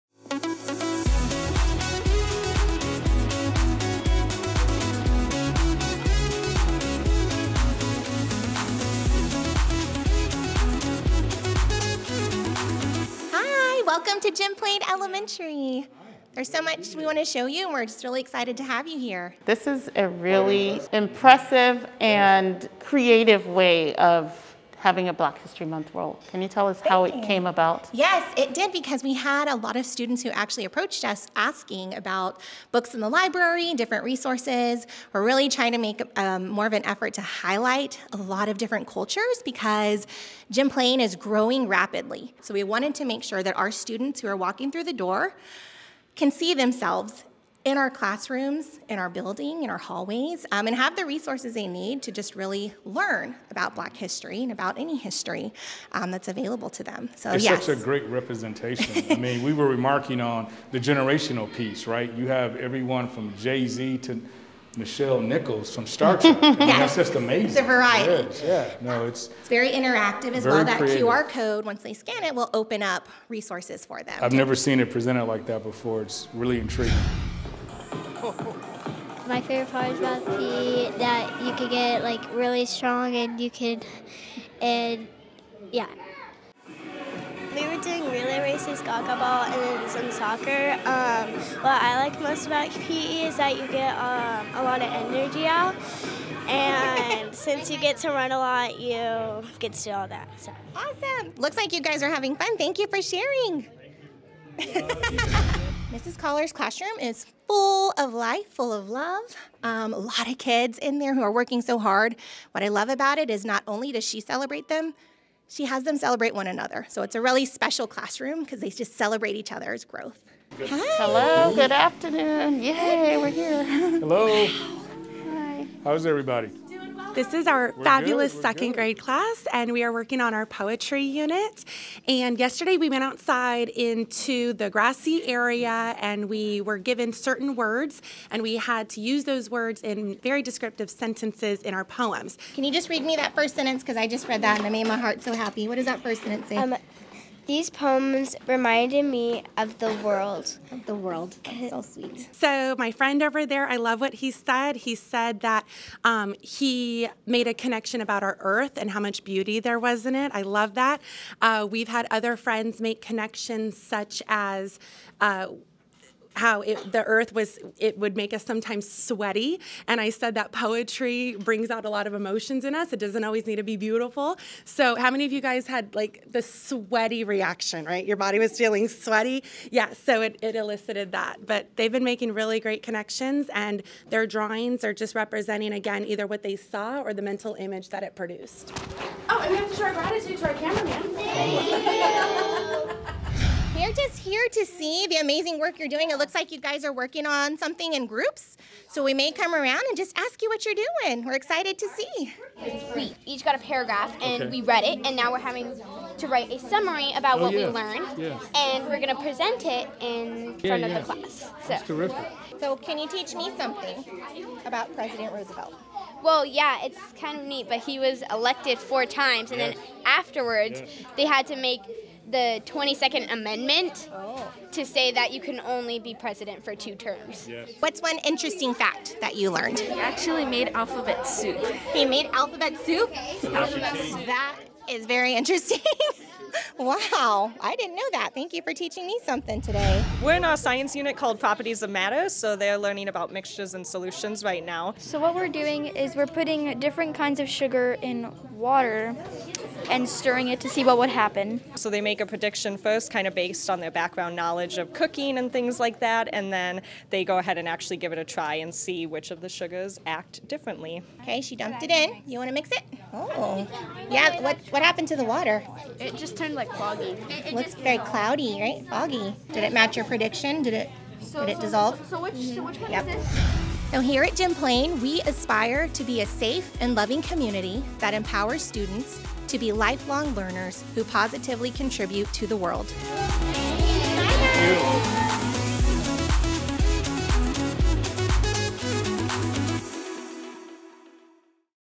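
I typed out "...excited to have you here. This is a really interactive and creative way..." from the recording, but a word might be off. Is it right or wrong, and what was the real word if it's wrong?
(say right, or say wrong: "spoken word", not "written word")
wrong: "impressive", not "interactive".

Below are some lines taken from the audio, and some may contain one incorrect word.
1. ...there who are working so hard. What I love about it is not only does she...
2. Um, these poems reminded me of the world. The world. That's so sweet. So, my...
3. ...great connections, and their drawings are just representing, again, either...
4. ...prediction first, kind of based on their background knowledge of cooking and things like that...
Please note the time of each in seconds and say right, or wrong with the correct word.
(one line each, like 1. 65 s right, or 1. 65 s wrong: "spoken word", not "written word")
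1. 110 s right
2. 146 s right
3. 182 s right
4. 252 s right.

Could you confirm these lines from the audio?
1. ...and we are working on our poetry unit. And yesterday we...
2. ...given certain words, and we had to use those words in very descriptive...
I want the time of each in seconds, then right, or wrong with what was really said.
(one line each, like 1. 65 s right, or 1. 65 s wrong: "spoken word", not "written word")
1. 129 s right
2. 136 s right.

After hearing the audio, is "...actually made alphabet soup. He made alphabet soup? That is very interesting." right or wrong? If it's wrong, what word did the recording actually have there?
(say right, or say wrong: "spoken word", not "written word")
right.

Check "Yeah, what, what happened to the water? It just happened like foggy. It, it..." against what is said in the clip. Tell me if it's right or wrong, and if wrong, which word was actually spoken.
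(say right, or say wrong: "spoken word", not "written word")
wrong: "turned", not "happened".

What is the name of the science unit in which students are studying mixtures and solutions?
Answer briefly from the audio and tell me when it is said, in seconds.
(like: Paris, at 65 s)
Properties of Matter, at 241 s.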